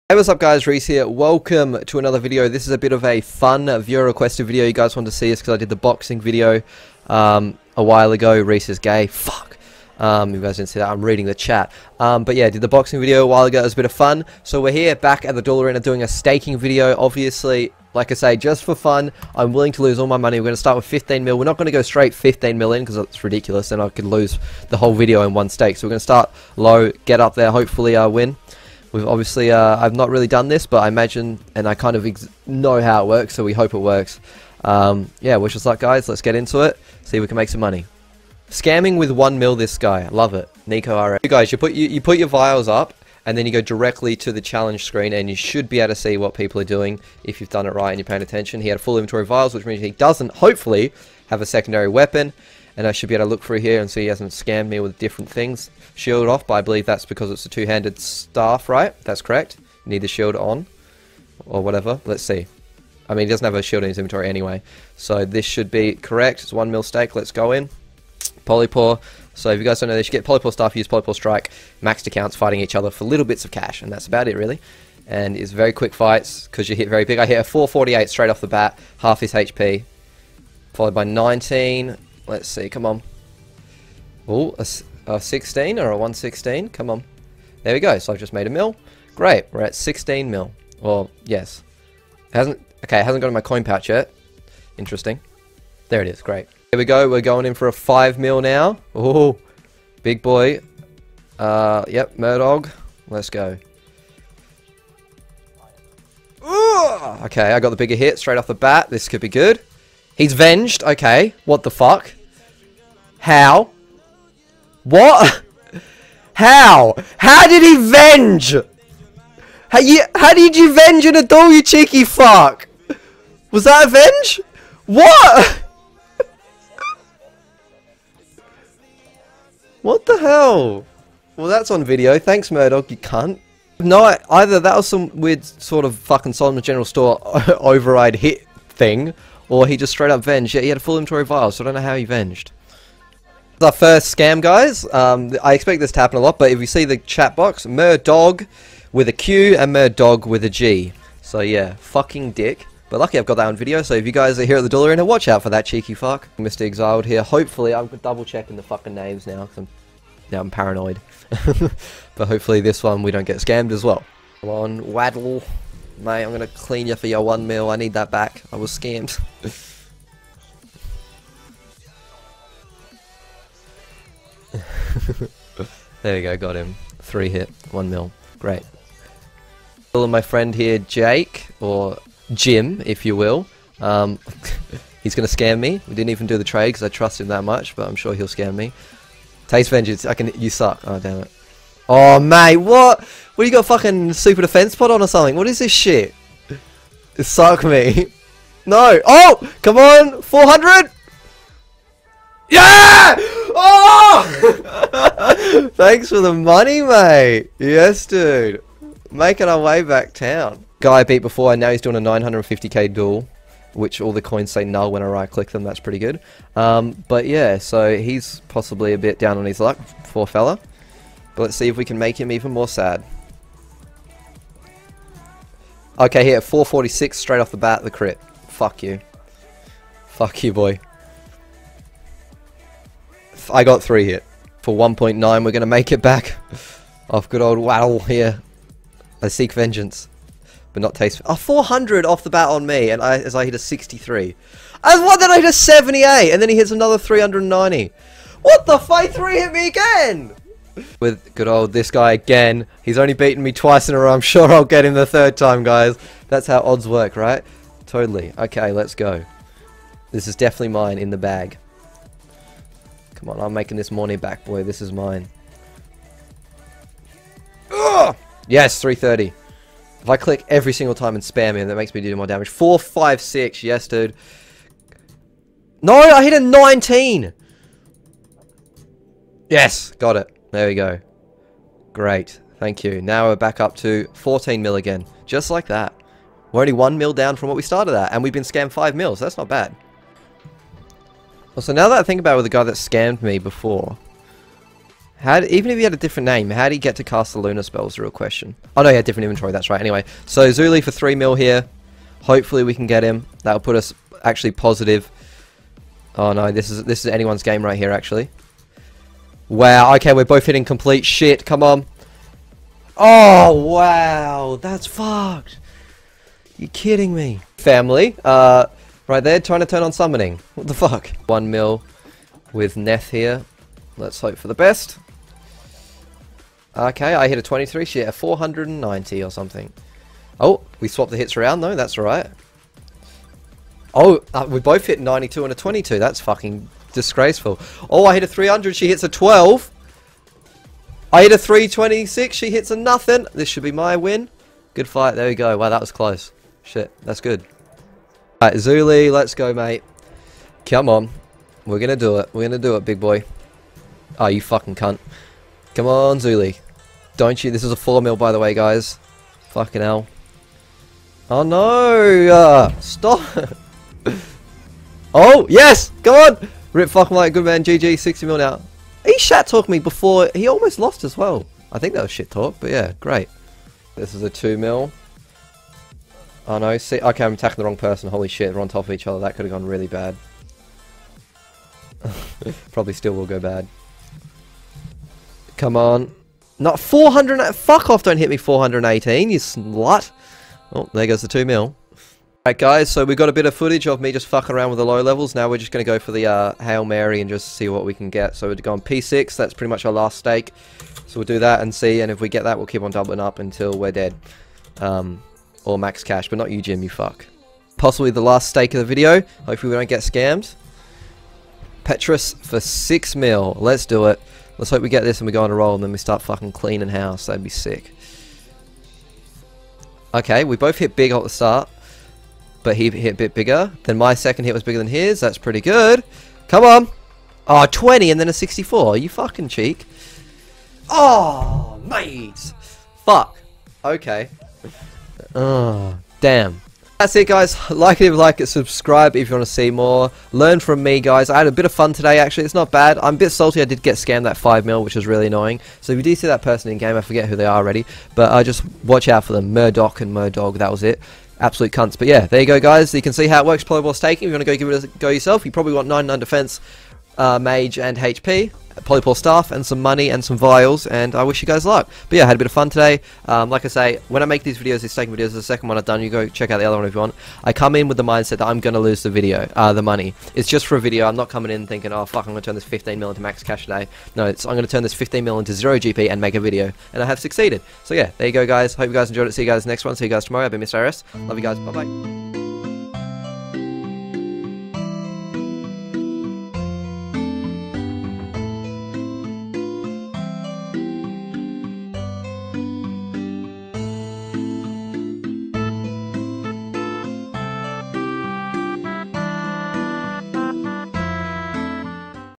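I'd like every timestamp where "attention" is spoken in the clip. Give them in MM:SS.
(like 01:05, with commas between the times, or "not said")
00:48.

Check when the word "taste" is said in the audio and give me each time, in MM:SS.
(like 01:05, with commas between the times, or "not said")
03:09, 04:00.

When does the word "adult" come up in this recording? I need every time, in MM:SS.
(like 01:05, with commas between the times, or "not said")
02:01.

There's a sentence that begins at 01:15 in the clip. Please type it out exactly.
And it's very quick fights because you hit very big.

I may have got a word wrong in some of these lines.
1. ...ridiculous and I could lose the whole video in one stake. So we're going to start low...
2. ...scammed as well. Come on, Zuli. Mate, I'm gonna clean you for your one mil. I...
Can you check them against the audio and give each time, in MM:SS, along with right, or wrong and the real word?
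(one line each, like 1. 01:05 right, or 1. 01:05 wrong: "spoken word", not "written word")
1. 00:23 right
2. 02:43 wrong: "Waddle", not "Zuli".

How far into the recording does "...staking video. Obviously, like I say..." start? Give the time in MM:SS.
00:16.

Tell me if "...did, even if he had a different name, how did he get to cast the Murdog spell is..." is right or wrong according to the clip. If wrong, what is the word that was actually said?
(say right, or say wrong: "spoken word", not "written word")
wrong: "Lunar", not "Murdog".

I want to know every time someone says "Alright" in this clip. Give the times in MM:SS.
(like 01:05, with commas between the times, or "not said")
05:48, 06:32.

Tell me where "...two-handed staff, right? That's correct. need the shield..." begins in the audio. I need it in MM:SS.
00:57.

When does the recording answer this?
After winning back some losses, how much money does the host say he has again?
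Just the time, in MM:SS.
04:44.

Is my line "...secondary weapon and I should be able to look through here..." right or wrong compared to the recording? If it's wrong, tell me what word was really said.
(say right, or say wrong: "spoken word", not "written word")
right.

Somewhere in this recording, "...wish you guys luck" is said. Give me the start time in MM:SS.
07:41.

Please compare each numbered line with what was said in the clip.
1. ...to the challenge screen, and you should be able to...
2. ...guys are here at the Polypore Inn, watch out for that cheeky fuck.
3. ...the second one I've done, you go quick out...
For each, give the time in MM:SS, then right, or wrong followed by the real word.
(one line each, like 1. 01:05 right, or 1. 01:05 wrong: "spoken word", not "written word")
1. 00:44 right
2. 02:34 wrong: "Dollar", not "Polypore"
3. 07:45 wrong: "check", not "quick".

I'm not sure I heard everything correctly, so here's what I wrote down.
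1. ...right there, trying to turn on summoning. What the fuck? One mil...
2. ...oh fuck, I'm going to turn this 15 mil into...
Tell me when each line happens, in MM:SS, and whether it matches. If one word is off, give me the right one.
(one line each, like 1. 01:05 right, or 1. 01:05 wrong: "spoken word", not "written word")
1. 05:19 right
2. 07:51 right.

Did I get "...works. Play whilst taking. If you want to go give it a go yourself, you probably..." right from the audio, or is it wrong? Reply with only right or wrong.
right.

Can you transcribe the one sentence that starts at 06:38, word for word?
So we are going P6, that's pretty much our last stake.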